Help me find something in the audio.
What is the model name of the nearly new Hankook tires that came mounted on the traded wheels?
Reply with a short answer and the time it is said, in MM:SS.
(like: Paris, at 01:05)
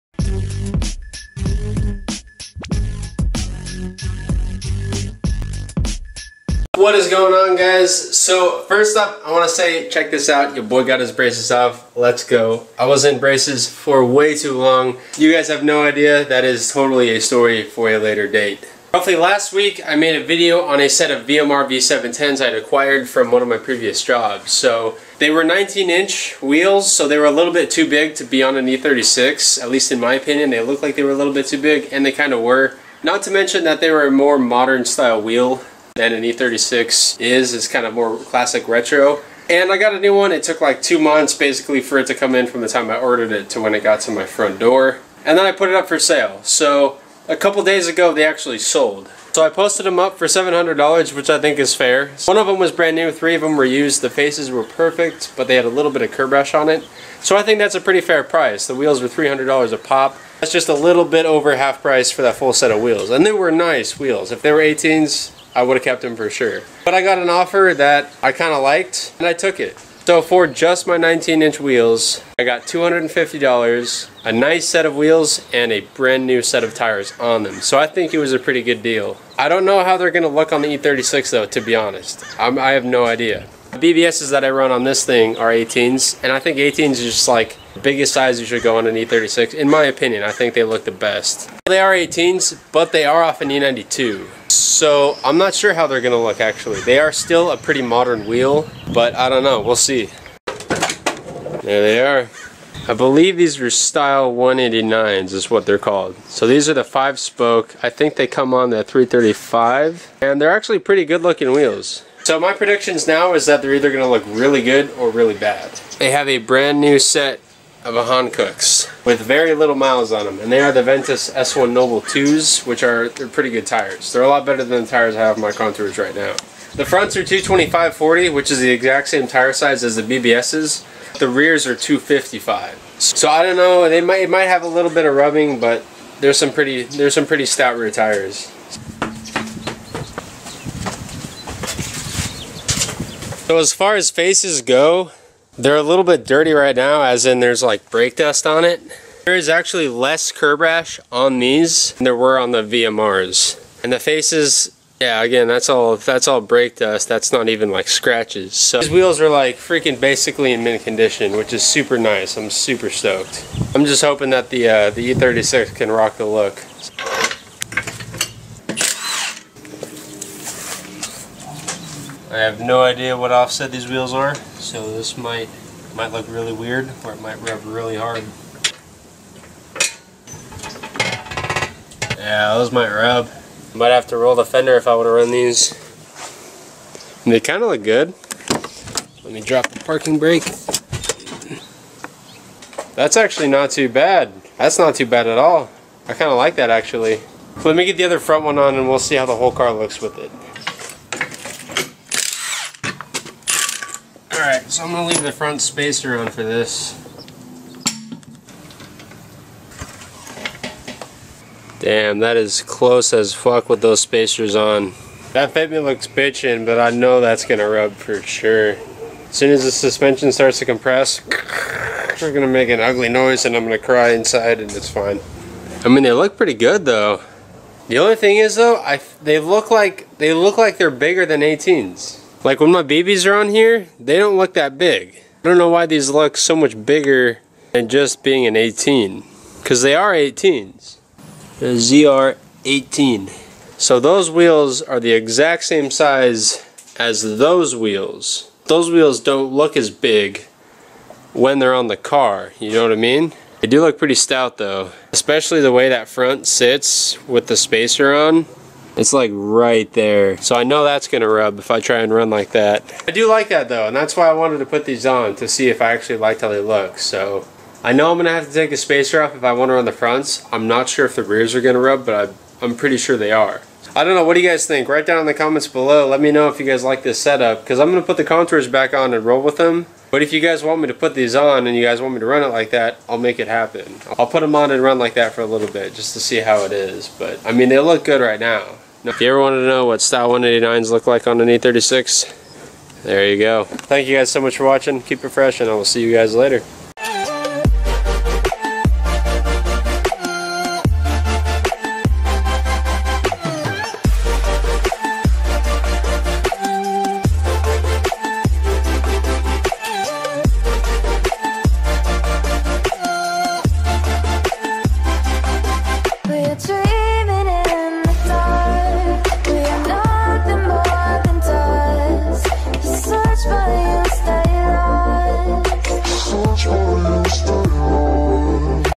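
Ventus S1 Noble 2, at 02:00.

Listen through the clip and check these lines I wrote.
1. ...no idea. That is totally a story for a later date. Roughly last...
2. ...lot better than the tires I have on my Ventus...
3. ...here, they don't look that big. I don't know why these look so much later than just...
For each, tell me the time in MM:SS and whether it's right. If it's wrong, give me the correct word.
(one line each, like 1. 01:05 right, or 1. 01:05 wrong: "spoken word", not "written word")
1. 00:15 right
2. 02:04 wrong: "Contours", not "Ventus"
3. 03:53 wrong: "bigger", not "later".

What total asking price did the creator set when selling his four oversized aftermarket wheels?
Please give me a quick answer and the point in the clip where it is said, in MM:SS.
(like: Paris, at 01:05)
$700, at 00:50.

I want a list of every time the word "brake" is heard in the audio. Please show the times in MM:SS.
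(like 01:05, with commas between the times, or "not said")
02:27, 02:36, 03:10.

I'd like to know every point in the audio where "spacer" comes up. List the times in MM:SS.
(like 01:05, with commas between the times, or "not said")
03:25, 03:33, 04:17, 04:28.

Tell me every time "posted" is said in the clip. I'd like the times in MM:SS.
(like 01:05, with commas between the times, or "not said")
00:49.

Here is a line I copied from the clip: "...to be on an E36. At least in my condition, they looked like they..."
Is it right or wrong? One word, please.
wrong.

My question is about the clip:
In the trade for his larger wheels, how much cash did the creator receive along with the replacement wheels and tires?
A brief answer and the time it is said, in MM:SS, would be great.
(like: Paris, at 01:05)
$250, at 01:12.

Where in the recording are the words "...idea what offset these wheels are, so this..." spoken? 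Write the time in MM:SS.
02:52.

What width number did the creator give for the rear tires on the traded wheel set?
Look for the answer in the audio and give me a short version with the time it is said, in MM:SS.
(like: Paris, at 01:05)
255, at 02:11.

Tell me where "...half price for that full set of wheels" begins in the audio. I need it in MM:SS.
01:01.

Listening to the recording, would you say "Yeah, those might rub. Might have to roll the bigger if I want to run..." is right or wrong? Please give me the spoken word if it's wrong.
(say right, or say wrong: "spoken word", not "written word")
wrong: "fender", not "bigger".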